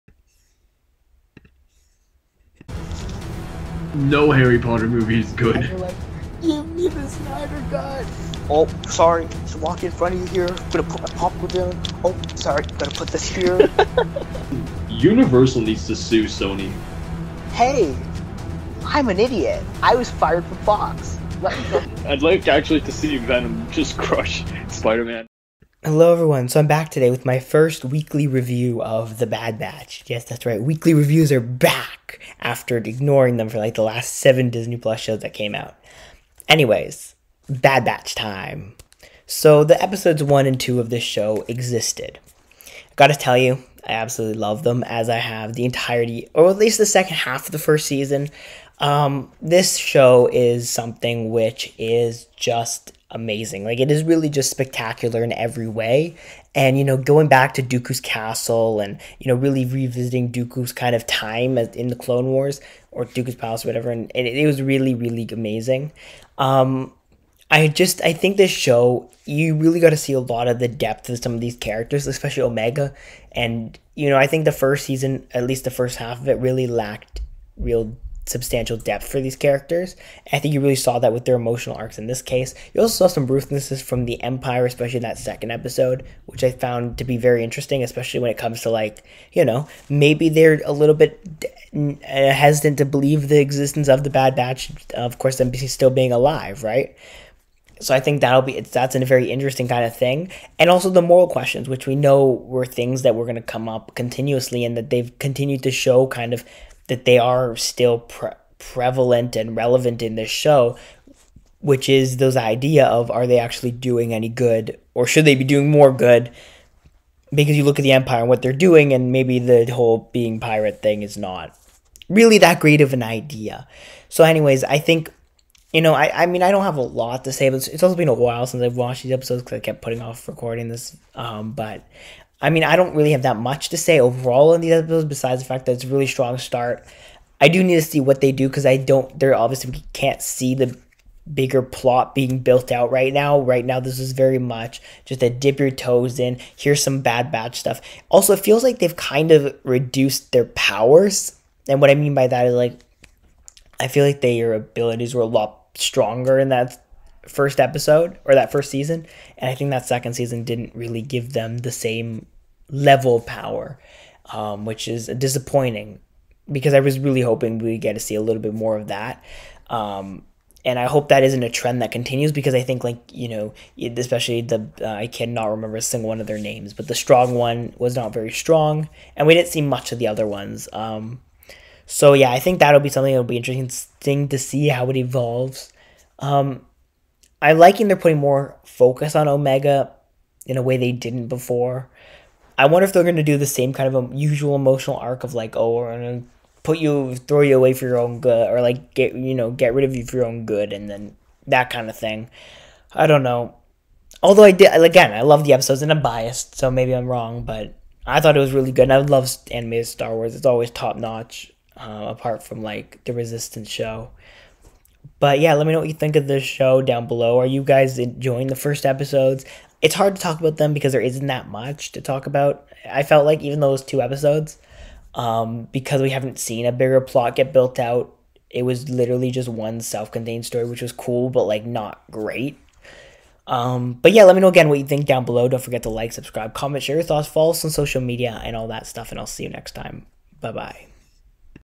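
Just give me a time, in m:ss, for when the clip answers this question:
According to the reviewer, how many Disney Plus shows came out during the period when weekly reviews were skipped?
0:34.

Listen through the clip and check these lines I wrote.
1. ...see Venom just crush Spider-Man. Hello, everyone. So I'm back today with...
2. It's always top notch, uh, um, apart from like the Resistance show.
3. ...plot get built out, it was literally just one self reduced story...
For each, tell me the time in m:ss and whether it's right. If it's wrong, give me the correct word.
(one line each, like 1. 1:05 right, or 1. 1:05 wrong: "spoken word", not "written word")
1. 0:22 right
2. 3:30 right
3. 3:47 wrong: "contained", not "reduced".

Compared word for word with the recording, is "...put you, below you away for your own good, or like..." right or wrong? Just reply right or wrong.
wrong.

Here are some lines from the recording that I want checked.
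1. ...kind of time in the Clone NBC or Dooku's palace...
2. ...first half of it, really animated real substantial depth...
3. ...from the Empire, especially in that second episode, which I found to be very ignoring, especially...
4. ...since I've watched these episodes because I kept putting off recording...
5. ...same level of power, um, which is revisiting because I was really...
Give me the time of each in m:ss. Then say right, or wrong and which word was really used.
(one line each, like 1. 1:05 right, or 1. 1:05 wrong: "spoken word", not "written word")
1. 1:00 wrong: "Wars", not "NBC"
2. 1:15 wrong: "lacked", not "animated"
3. 1:23 wrong: "interesting", not "ignoring"
4. 2:08 right
5. 2:41 wrong: "disappointing", not "revisiting".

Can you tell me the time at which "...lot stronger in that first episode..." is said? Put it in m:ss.
2:35.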